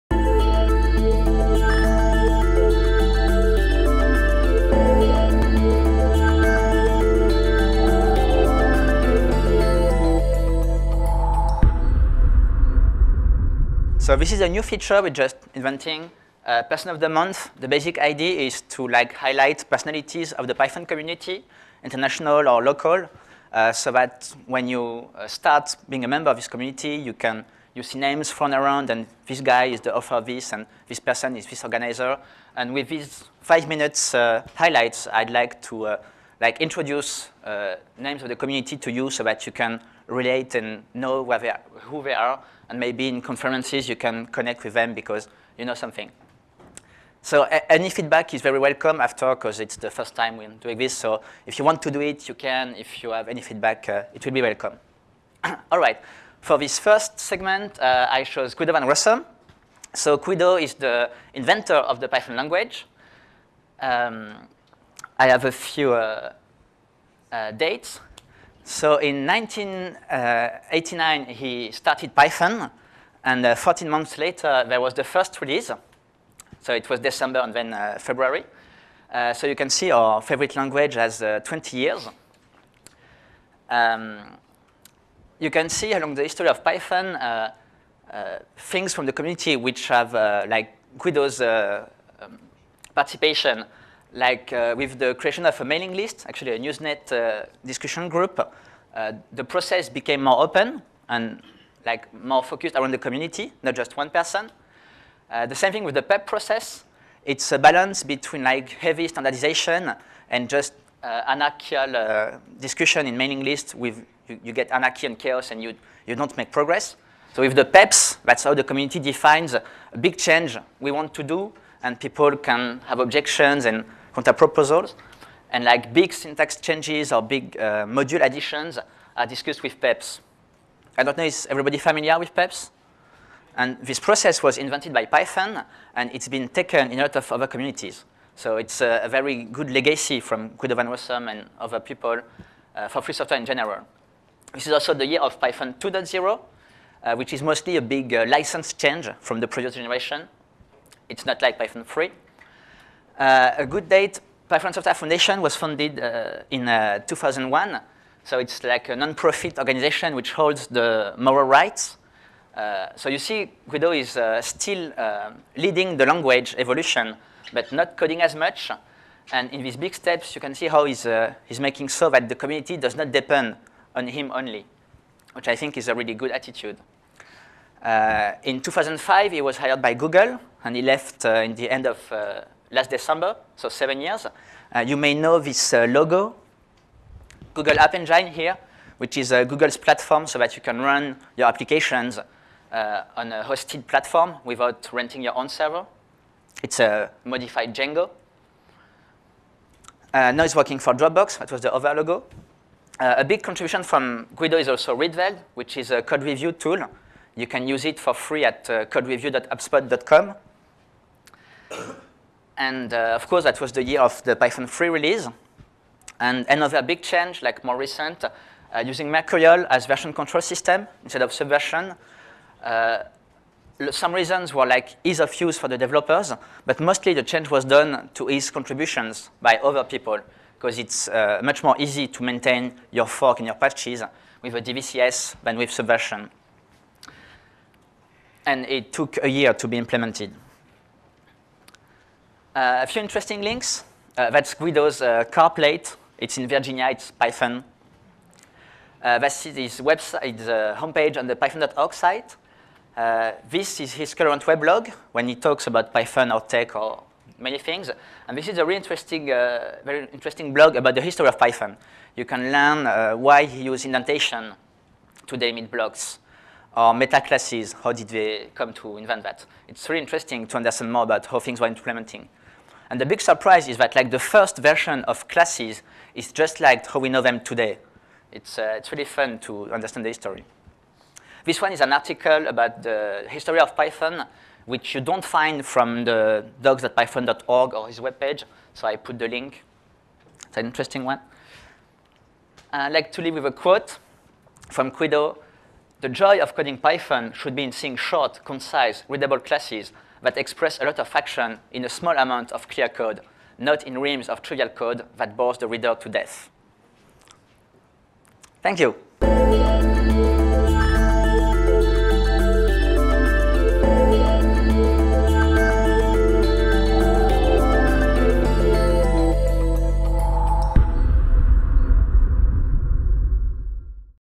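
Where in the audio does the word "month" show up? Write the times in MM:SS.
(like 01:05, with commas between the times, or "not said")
00:17, 01:13.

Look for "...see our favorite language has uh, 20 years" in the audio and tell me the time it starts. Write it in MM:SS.
01:19.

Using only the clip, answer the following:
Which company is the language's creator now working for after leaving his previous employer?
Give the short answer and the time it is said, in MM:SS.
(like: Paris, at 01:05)
Dropbox, at 03:20.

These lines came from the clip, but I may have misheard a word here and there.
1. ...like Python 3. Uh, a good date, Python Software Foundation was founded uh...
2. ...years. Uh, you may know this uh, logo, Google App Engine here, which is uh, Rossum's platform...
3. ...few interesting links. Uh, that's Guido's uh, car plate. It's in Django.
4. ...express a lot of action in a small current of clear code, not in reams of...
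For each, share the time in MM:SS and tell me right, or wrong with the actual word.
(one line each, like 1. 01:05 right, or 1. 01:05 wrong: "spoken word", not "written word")
1. 02:31 right
2. 03:04 wrong: "Google", not "Rossum"
3. 04:02 wrong: "Virginia", not "Django"
4. 05:00 wrong: "amount", not "current".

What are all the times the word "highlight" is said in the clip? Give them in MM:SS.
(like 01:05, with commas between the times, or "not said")
00:19, 00:34.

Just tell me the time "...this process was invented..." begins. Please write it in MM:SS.
02:13.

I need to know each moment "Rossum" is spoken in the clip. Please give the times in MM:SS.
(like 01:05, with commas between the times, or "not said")
00:58, 02:20.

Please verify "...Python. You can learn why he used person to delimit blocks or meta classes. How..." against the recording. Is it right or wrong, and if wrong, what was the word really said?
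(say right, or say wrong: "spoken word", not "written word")
wrong: "indentation", not "person".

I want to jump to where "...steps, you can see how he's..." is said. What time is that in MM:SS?
02:49.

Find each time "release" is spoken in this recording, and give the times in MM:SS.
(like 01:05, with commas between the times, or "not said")
01:15, 03:34.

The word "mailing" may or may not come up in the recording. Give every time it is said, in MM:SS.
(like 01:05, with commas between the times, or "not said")
01:35, 01:53.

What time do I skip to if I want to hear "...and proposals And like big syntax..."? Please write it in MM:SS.
02:03.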